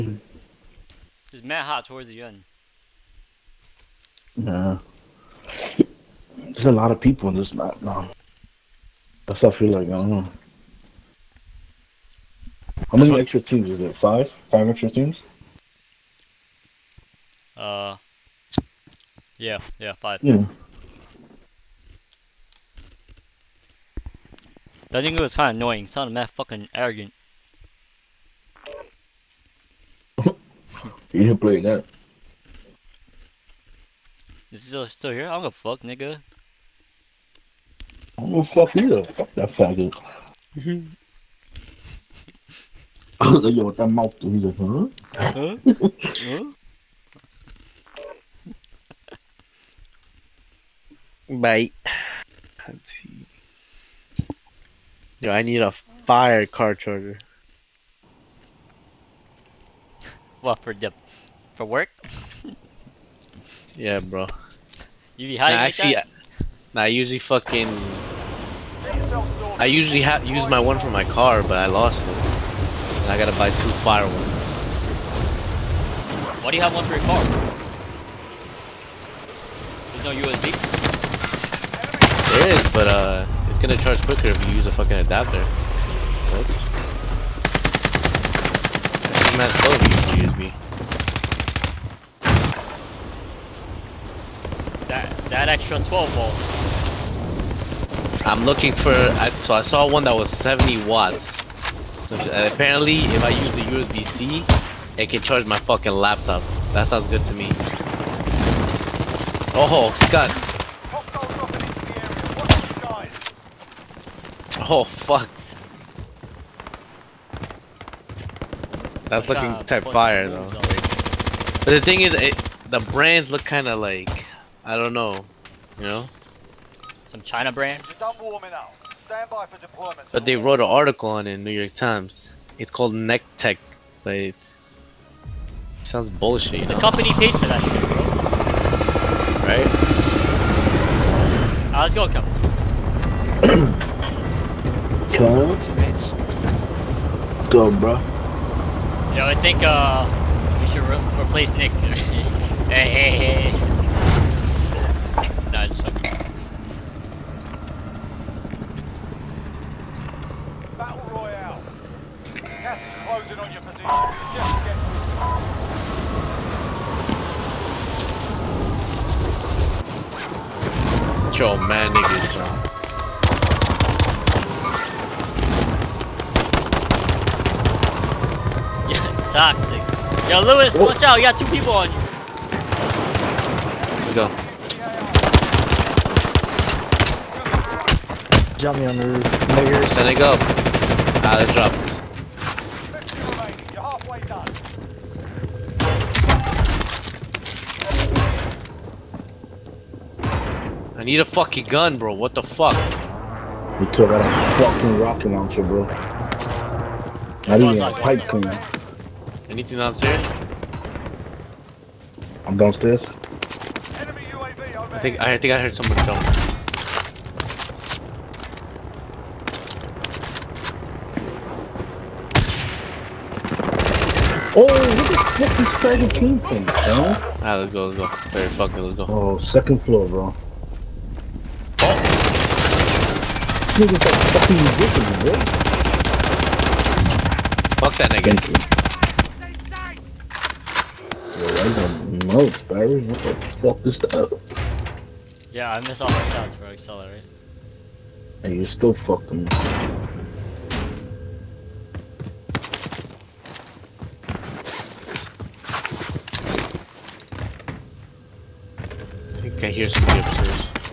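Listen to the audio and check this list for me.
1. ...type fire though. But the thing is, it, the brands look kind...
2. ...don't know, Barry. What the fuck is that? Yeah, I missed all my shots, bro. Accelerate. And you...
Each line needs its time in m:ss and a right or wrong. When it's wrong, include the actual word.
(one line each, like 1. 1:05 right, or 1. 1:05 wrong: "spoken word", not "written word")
1. 1:59 right
2. 4:01 right.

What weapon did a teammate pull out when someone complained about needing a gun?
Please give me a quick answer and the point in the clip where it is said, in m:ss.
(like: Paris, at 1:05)
Rocket launcher, at 3:24.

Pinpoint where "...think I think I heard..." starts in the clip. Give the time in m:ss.
3:35.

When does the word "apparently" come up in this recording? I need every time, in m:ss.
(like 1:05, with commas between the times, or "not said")
1:42.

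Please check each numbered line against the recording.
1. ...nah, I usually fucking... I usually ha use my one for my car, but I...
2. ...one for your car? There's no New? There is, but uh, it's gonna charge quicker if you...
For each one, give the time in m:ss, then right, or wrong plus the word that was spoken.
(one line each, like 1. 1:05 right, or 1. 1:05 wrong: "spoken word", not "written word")
1. 1:06 right
2. 1:16 wrong: "USB", not "New".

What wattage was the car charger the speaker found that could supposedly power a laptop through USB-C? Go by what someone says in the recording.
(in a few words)
70 watts.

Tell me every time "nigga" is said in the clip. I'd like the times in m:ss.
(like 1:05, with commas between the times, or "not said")
0:35, 2:51, 3:53, 3:58.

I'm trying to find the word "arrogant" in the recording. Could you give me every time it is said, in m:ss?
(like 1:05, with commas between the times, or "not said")
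0:26.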